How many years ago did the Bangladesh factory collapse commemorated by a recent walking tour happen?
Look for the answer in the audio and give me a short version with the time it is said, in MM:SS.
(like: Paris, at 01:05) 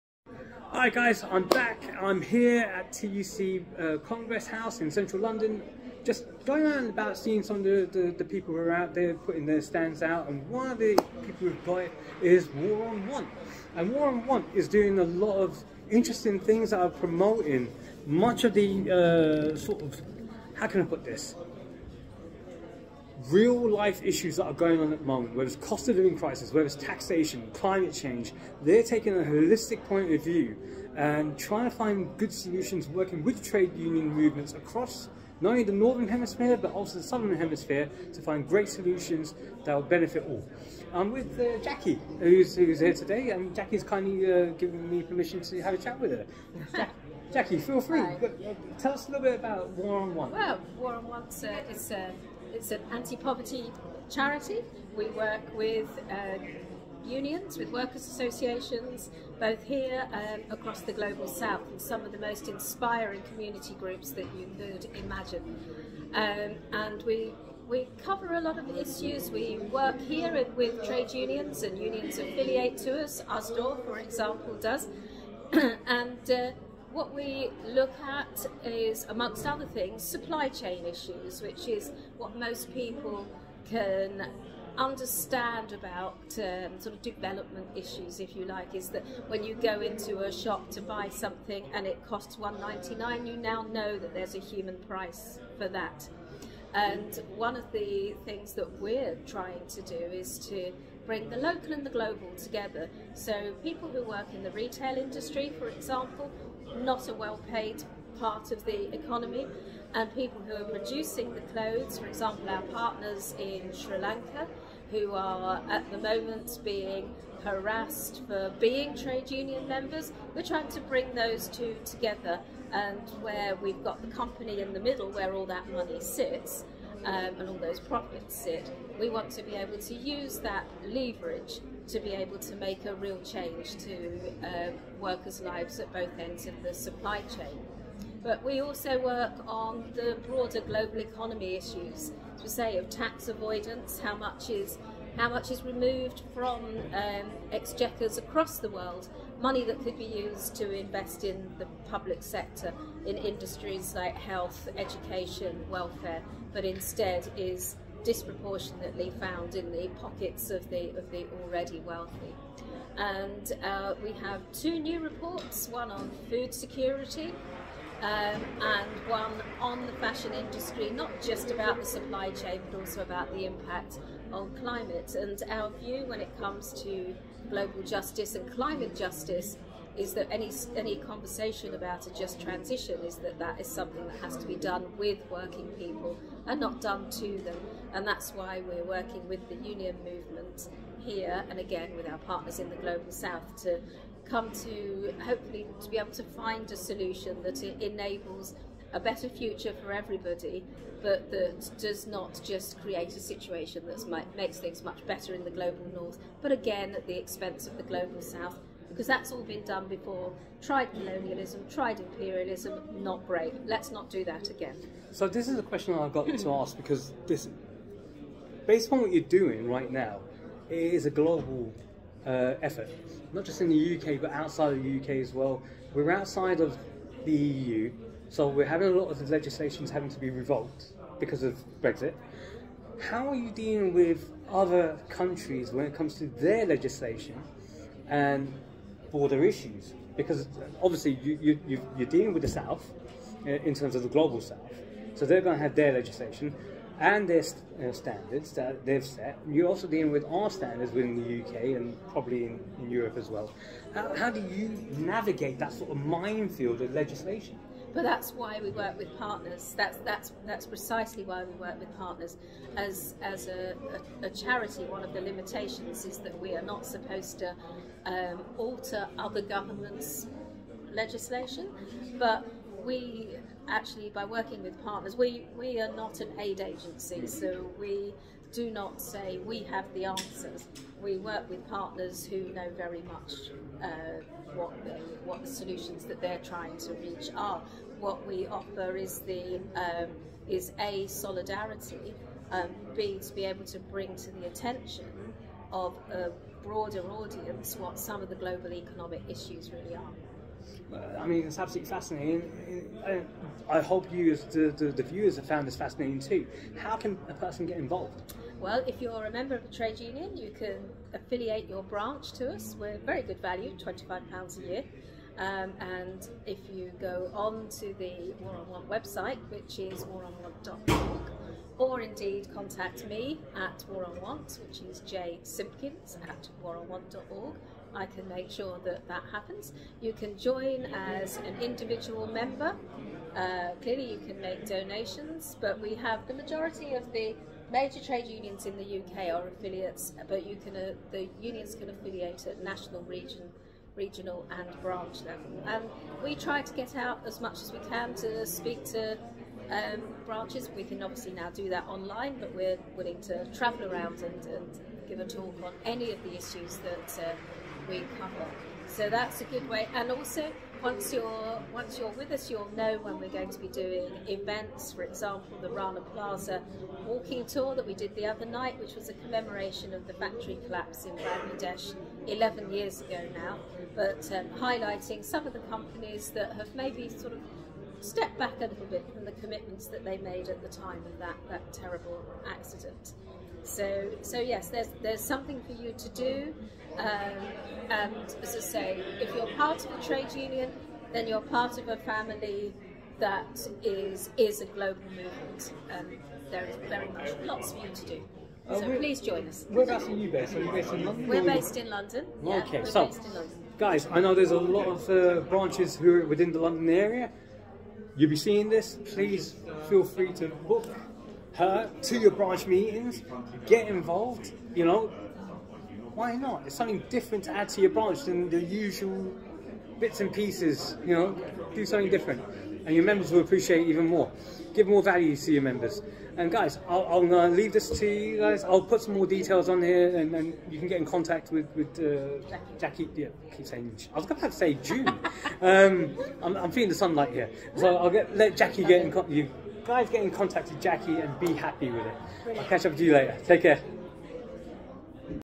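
11, at 06:12.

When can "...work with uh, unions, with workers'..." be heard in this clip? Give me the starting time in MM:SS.
00:55.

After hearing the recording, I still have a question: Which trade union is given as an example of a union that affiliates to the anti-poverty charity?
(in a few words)
ASDOR.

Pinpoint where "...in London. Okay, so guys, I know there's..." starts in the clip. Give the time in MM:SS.
06:41.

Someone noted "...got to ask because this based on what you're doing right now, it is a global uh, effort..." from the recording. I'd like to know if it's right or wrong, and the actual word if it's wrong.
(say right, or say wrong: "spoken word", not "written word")
right.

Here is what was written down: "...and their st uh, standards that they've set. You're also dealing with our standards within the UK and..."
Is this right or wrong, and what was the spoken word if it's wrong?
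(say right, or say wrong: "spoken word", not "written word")
right.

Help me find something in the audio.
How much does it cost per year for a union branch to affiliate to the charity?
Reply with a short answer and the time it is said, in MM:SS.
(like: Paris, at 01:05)
£25, at 05:13.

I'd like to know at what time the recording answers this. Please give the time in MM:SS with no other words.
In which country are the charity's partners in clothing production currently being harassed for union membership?
01:53.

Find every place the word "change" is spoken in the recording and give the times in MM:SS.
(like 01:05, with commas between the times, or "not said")
00:27, 02:13.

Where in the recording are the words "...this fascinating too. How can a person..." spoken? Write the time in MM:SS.
05:05.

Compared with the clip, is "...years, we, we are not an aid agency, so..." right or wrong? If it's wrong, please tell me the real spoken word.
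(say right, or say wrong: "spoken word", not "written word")
wrong: "partners", not "years".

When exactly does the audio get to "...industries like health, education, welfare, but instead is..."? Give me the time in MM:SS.
02:33.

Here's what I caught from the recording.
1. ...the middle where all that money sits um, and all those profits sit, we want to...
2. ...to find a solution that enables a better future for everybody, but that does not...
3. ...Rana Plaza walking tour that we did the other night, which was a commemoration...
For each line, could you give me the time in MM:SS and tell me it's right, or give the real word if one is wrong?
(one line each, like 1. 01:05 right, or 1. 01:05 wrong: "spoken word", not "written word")
1. 02:04 right
2. 03:16 right
3. 06:05 right.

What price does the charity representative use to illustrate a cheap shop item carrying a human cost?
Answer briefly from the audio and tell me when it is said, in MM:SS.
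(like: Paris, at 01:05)
1.99, at 01:32.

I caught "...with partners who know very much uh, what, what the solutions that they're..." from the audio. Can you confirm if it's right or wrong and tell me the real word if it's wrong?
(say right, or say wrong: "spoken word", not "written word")
right.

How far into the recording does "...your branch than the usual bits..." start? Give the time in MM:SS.
06:57.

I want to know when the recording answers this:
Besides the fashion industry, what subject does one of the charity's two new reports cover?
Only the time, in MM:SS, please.
02:46.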